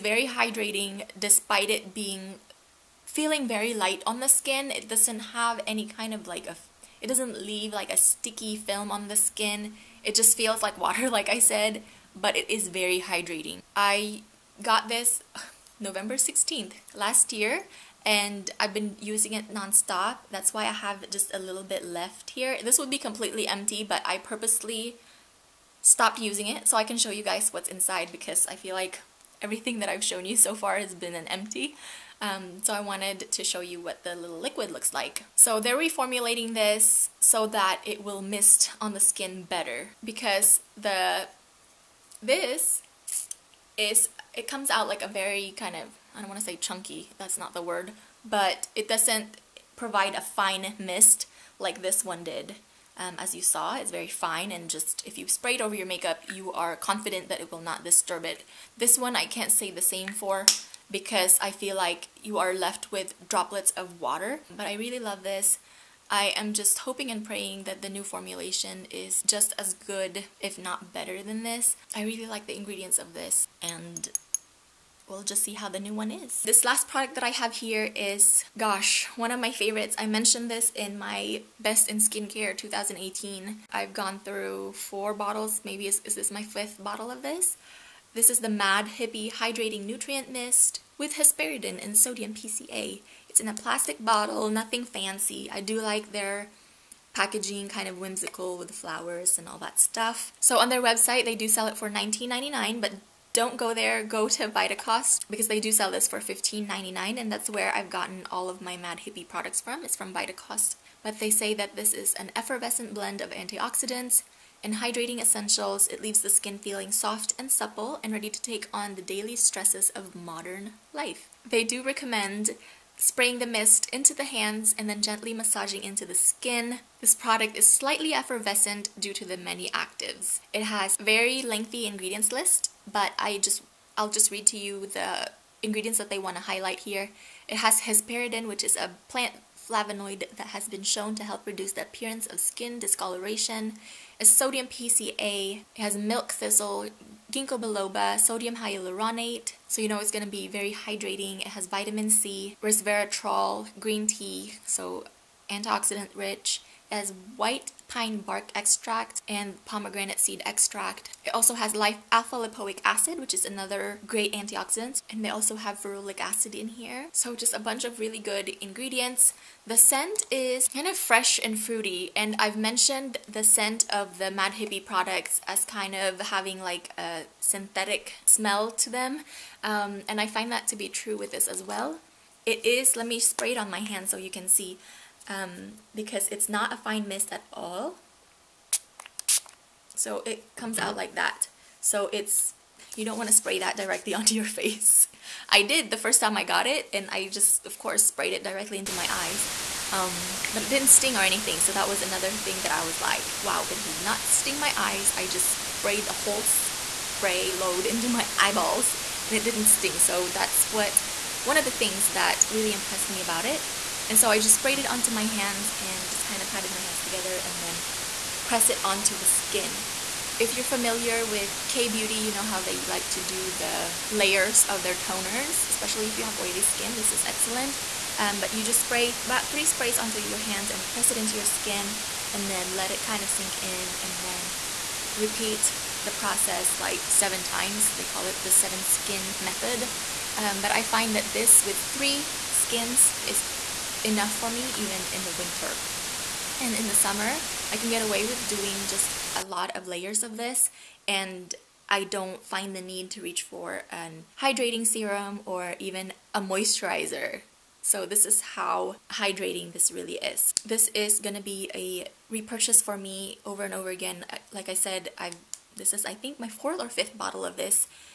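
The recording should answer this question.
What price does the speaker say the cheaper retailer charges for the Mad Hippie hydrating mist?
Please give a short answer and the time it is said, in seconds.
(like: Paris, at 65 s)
$15.99, at 106 s.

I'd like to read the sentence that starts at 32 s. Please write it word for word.
Um, so I wanted to show you what the little liquid looks like.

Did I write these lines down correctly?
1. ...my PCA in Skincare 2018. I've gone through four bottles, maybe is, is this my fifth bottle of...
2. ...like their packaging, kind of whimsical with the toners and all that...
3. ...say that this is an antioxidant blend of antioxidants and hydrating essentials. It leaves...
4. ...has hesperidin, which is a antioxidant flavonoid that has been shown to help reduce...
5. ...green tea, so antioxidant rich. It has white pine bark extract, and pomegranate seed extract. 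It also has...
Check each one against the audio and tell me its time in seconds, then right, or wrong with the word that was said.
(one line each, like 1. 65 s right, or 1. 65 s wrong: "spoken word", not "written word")
1. 80 s wrong: "Best", not "PCA"
2. 95 s wrong: "flowers", not "toners"
3. 111 s wrong: "effervescent", not "antioxidant"
4. 137 s wrong: "plant", not "antioxidant"
5. 153 s right.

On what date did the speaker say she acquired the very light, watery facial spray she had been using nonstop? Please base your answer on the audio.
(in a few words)
November 16th.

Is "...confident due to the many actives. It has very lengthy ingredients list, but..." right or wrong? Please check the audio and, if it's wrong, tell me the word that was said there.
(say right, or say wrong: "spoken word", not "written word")
wrong: "effervescent", not "confident".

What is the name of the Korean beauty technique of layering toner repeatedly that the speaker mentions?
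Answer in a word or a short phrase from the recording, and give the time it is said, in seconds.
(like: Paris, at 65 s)
seven skin method, at 238 s.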